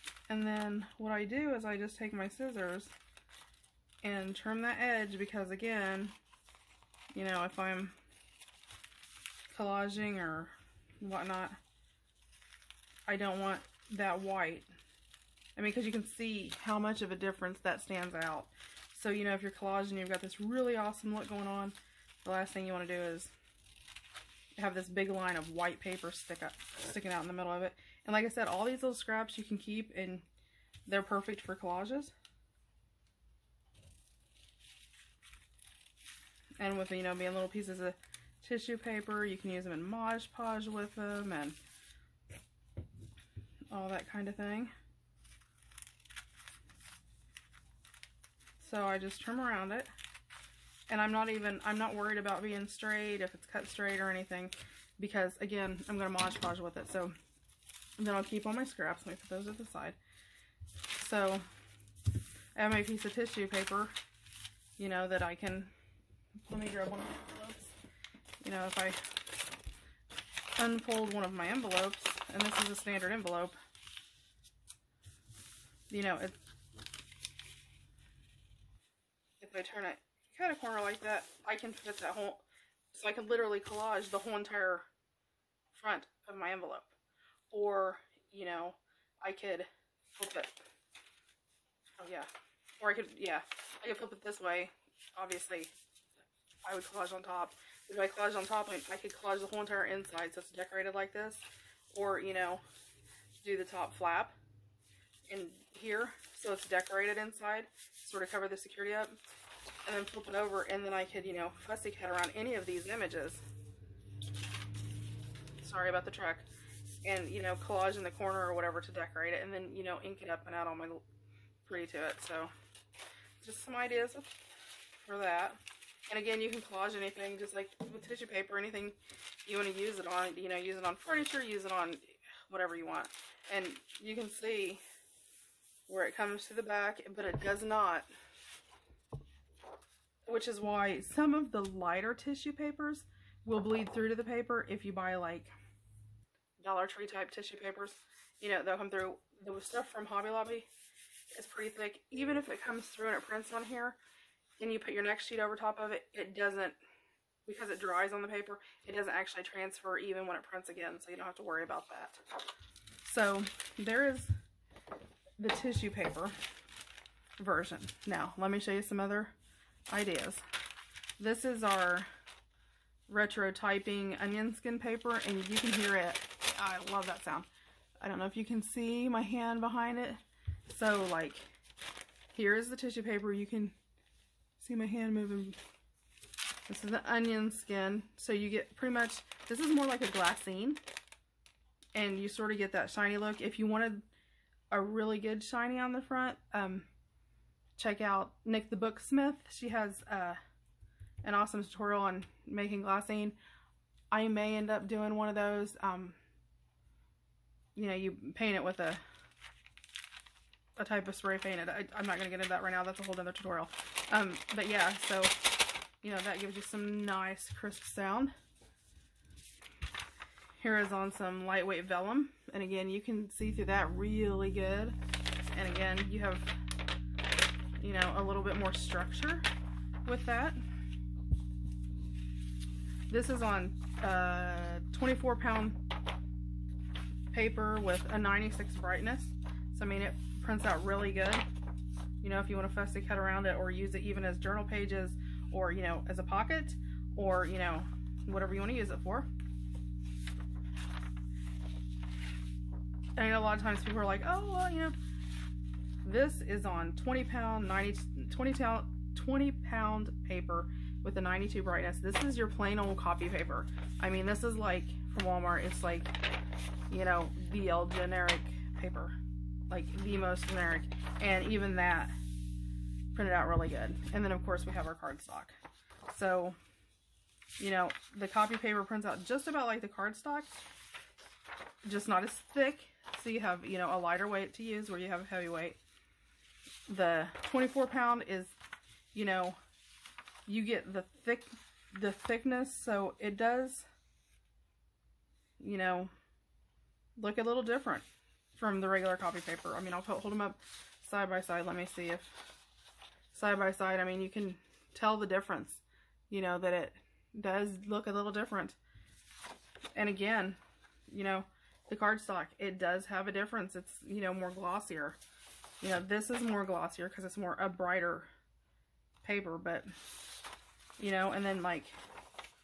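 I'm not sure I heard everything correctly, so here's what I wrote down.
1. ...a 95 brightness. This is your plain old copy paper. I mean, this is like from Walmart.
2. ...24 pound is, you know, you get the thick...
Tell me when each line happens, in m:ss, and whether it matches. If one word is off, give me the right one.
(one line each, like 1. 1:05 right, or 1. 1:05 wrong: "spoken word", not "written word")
1. 4:21 wrong: "92", not "95"
2. 4:47 right.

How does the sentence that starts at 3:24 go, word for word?
I may end up doing one of those.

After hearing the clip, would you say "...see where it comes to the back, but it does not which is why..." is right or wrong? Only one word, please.
right.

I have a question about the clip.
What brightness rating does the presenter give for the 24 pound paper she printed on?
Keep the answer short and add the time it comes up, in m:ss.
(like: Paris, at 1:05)
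96, at 3:58.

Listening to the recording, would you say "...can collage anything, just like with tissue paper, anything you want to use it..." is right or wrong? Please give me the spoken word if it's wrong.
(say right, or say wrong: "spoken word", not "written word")
right.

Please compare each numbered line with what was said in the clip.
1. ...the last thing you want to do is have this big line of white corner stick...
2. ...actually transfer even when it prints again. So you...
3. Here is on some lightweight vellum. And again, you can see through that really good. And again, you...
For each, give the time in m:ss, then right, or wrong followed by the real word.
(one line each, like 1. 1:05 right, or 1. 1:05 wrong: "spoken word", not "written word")
1. 0:22 wrong: "paper", not "corner"
2. 2:39 right
3. 3:40 right.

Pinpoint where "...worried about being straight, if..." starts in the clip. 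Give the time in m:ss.
0:51.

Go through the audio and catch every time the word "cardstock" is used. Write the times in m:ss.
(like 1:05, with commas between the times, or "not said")
4:34, 4:39, 5:11.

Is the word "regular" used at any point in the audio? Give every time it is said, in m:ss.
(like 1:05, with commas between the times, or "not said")
4:58.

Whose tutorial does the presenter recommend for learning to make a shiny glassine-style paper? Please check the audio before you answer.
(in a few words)
Nik the Booksmith.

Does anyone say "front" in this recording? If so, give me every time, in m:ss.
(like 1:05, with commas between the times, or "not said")
1:25, 3:16.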